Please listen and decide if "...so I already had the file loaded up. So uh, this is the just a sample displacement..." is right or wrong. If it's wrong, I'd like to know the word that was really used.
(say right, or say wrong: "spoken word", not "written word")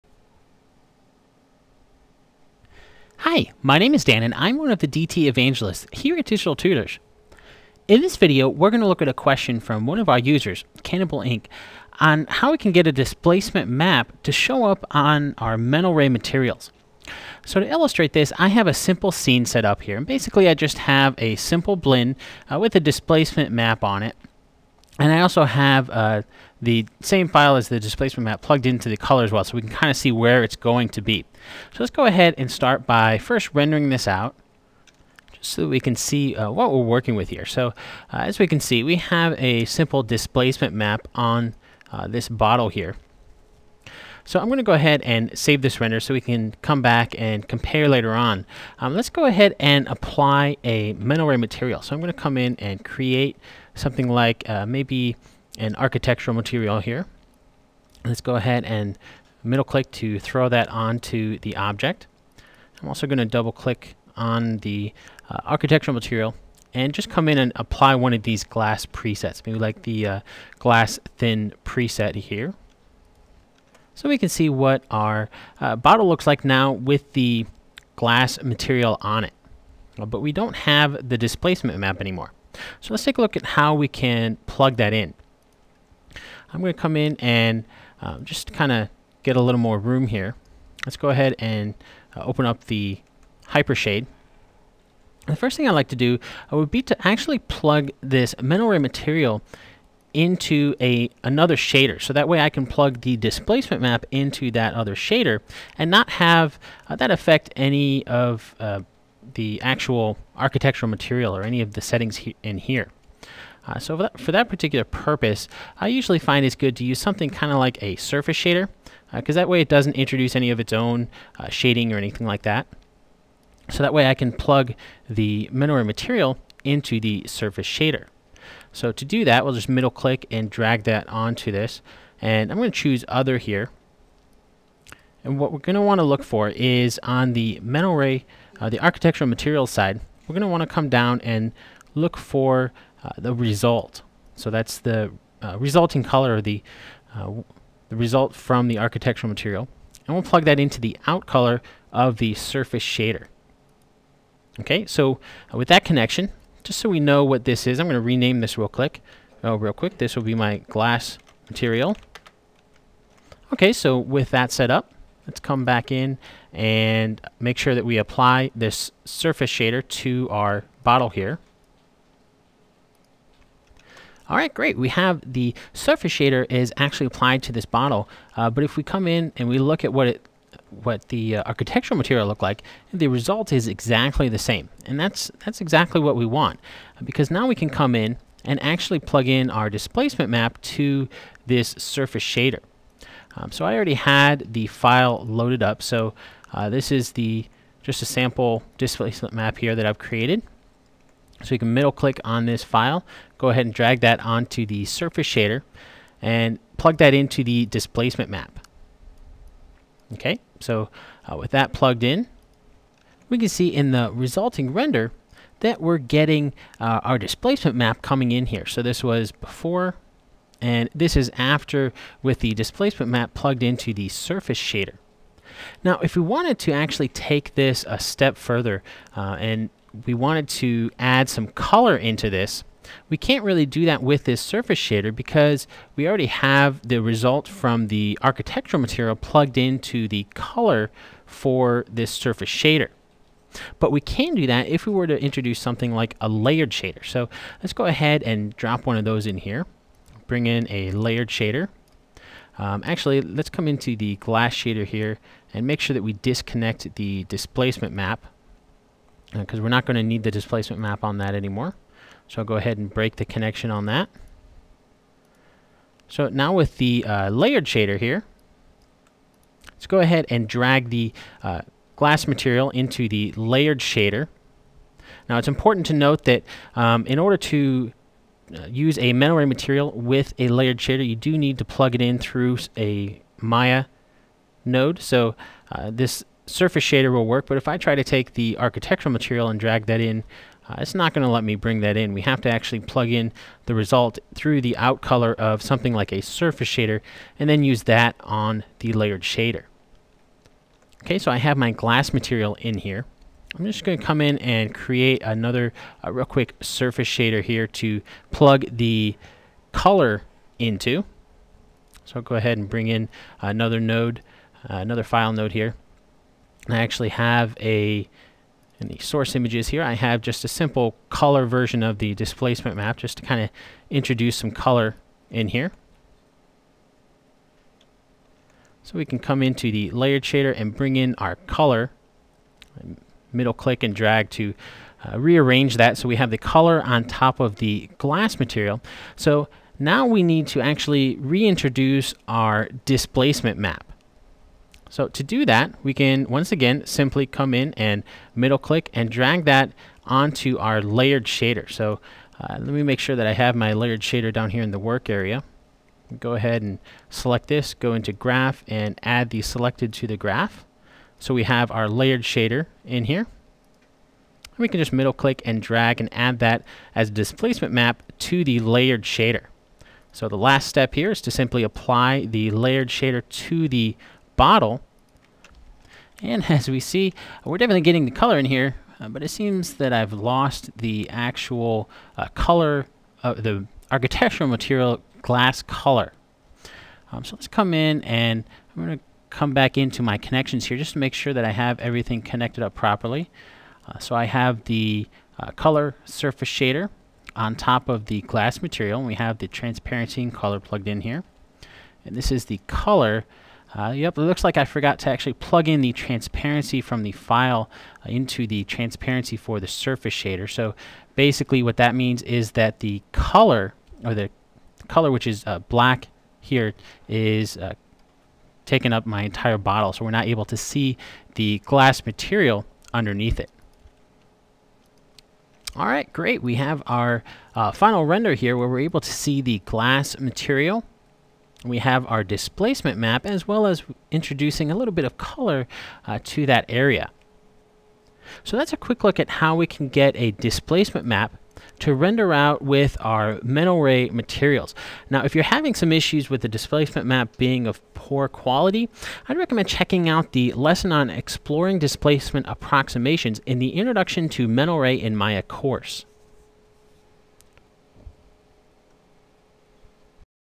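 right.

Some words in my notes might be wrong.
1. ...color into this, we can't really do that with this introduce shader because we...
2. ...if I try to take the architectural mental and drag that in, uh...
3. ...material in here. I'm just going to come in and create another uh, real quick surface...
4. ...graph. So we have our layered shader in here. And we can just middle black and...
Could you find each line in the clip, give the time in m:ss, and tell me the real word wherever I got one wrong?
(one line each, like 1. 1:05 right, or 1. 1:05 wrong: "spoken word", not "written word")
1. 3:51 wrong: "surface", not "introduce"
2. 4:47 wrong: "material", not "mental"
3. 5:02 right
4. 6:00 wrong: "click", not "black".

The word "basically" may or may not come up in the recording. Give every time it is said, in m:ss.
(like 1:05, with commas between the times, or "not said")
0:20, 6:51.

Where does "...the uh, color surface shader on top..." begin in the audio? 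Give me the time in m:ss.
6:34.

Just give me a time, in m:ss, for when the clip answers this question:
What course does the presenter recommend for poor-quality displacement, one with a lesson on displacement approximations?
7:33.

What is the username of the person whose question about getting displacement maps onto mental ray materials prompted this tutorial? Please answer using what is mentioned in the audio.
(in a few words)
cannibalink.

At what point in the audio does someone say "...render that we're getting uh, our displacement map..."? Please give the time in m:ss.
3:34.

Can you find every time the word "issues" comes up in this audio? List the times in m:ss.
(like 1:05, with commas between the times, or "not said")
7:25.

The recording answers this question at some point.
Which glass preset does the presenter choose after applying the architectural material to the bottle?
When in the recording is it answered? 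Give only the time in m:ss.
1:10.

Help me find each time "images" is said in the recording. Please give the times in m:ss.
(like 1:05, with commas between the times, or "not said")
5:19.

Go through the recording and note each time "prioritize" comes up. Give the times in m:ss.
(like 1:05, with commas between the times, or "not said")
not said.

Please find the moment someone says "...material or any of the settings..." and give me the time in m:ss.
1:50.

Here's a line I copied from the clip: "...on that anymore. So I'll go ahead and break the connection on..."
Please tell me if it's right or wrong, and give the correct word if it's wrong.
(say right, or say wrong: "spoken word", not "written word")
right.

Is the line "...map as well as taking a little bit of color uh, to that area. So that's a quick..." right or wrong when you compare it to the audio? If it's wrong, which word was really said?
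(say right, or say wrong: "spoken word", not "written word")
wrong: "introducing", not "taking".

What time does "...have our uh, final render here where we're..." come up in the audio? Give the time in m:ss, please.
7:06.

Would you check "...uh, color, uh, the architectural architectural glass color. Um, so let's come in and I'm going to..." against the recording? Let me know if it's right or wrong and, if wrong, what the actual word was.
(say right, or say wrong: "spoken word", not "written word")
wrong: "material", not "architectural".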